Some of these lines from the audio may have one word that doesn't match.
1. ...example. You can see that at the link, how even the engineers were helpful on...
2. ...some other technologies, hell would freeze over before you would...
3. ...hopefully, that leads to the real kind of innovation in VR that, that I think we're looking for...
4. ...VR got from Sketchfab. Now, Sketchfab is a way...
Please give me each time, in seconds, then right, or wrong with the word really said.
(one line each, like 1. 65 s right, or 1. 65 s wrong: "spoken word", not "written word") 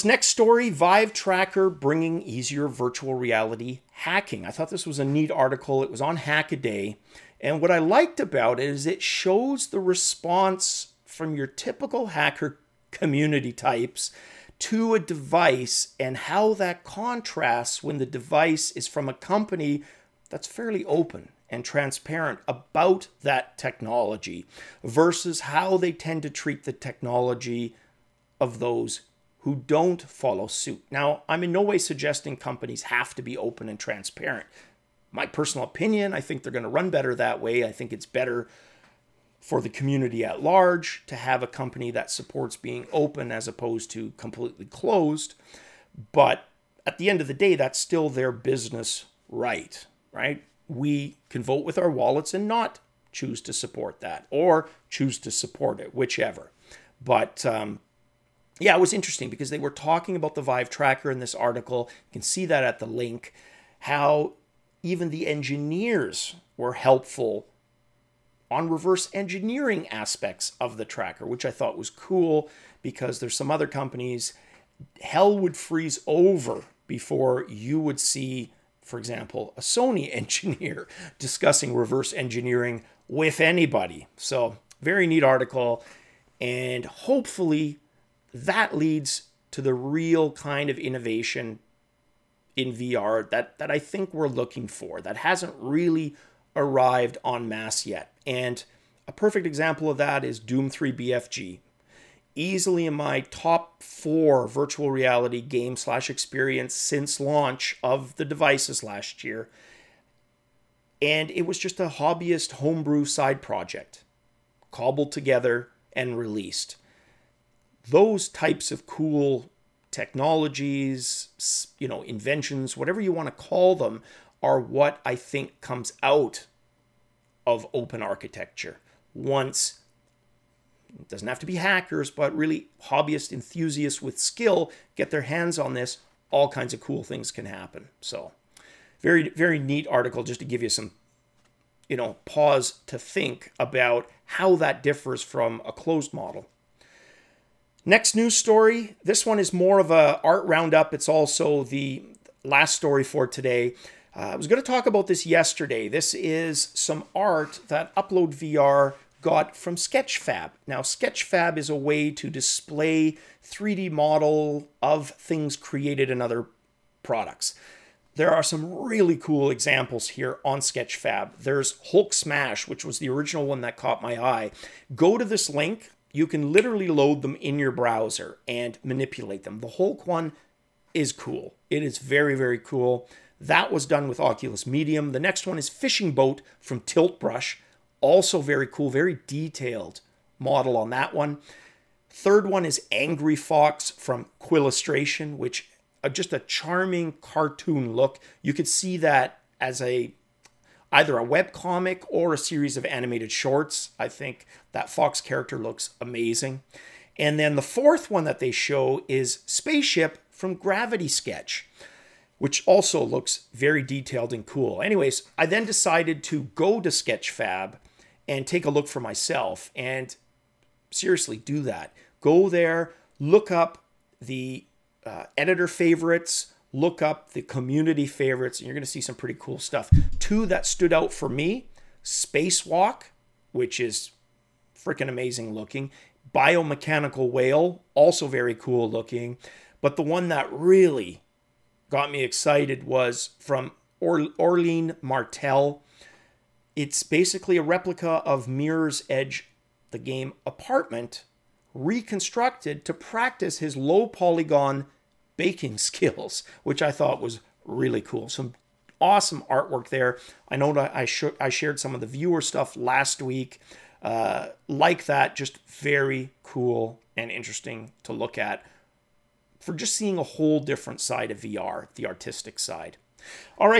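1. 61 s wrong: "article", not "example"
2. 73 s wrong: "companies", not "technologies"
3. 86 s right
4. 158 s right.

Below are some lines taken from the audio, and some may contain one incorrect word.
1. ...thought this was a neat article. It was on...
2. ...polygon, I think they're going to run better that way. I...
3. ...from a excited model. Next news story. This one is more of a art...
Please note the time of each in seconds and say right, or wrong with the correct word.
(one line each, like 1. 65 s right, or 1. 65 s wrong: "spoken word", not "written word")
1. 4 s right
2. 35 s wrong: "opinion", not "polygon"
3. 145 s wrong: "closed", not "excited".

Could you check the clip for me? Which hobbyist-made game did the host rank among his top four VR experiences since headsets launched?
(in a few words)
Doom 3 BFG.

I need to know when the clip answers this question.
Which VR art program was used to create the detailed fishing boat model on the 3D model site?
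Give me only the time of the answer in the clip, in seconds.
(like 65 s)
186 s.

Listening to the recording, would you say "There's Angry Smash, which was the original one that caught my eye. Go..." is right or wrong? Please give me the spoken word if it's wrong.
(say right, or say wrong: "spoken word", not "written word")
wrong: "Hulk", not "Angry".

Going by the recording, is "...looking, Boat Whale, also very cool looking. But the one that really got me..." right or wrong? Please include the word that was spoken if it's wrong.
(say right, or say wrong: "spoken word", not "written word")
wrong: "Biomechanical", not "Boat".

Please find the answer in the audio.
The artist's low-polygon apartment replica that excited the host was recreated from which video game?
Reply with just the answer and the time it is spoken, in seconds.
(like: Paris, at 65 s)
Mirror's Edge, at 248 s.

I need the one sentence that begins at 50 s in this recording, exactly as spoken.
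We can vote with our wallets and not choose to support that or choose to support it, whichever.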